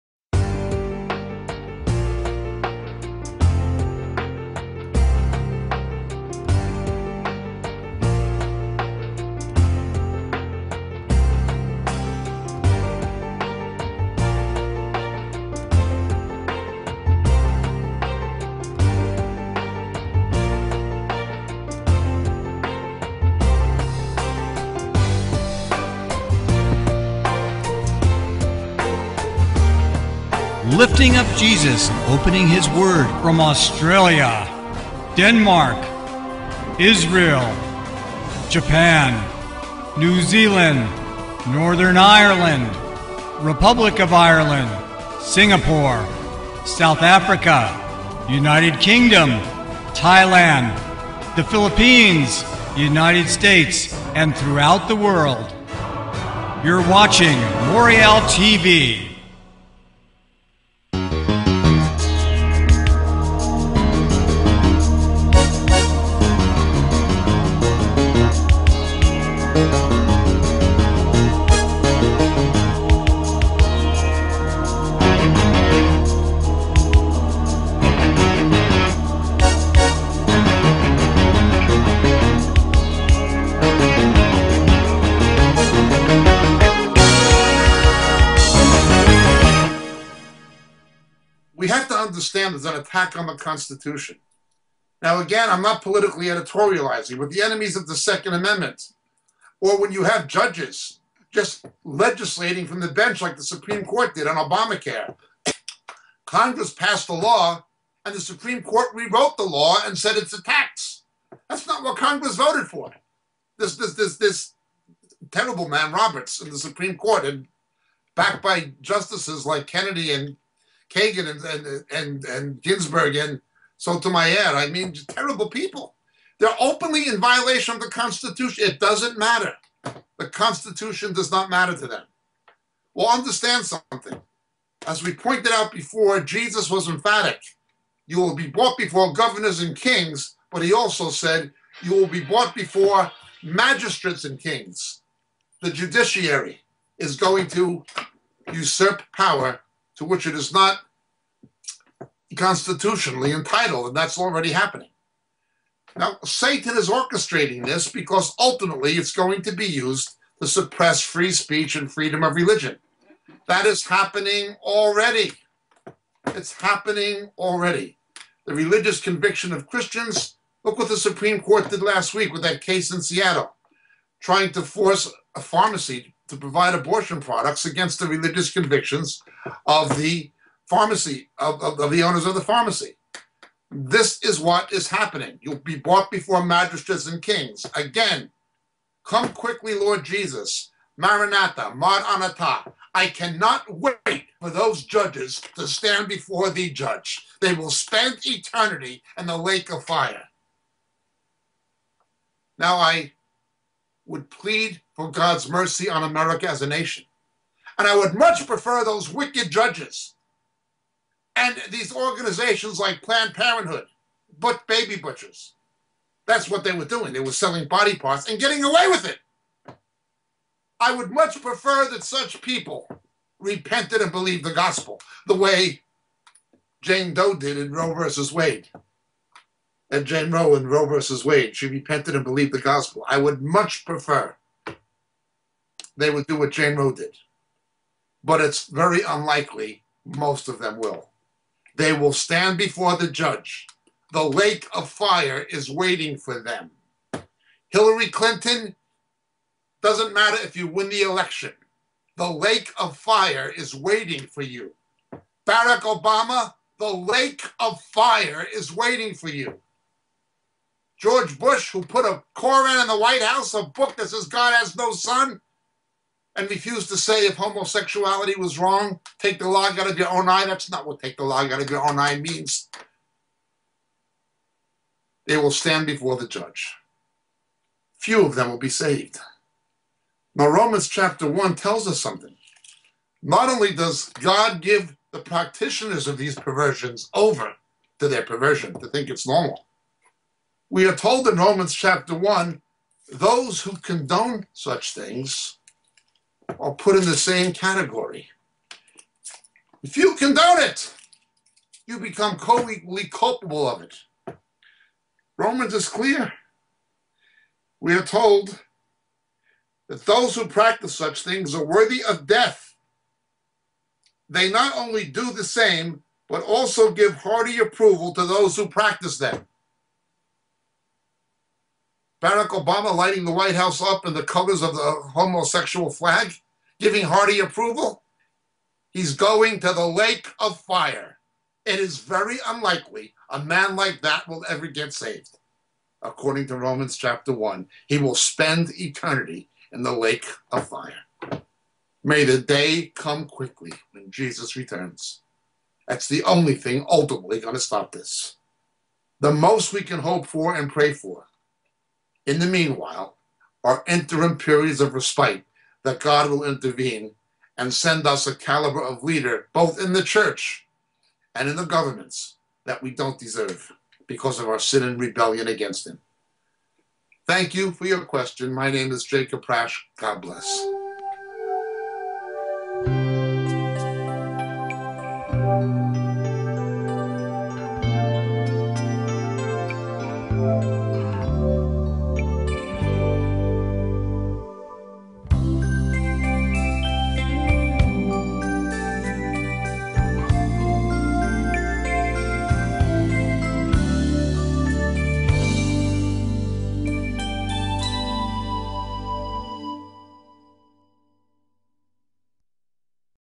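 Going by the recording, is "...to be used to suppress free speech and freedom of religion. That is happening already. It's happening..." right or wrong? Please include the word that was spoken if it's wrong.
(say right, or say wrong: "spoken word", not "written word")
right.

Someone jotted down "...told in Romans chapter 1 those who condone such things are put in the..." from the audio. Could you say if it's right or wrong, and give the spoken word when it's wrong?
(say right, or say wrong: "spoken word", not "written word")
right.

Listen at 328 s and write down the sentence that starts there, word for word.
He's going to the lake of fire.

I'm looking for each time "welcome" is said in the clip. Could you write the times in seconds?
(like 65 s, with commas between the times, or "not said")
not said.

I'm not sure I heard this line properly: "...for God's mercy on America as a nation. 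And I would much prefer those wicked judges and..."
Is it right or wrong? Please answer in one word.
right.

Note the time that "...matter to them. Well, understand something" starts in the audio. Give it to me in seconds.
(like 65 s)
131 s.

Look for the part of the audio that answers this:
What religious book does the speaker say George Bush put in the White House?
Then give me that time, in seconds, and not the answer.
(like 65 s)
262 s.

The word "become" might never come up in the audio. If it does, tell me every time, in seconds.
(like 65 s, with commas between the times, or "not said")
301 s.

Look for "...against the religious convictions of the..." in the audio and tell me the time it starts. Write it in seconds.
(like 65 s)
177 s.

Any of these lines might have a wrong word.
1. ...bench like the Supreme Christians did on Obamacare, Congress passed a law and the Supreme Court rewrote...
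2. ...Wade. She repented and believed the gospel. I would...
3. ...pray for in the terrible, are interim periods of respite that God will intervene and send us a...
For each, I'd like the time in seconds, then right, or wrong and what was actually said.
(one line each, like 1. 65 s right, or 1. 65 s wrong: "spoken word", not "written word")
1. 102 s wrong: "Court", not "Christians"
2. 231 s right
3. 350 s wrong: "meanwhile", not "terrible".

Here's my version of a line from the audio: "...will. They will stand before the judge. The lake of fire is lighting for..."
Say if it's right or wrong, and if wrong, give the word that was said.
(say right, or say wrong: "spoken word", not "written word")
wrong: "waiting", not "lighting".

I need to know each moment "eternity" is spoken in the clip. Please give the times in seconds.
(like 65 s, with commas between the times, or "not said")
198 s, 338 s.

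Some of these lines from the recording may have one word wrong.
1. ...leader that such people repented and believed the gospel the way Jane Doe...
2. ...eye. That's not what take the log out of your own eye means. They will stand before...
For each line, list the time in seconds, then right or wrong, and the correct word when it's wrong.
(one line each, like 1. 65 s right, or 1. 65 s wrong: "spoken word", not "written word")
1. 221 s wrong: "prefer", not "leader"
2. 270 s right.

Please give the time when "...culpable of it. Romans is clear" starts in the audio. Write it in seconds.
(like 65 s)
303 s.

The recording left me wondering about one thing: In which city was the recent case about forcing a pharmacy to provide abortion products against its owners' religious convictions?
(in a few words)
Seattle.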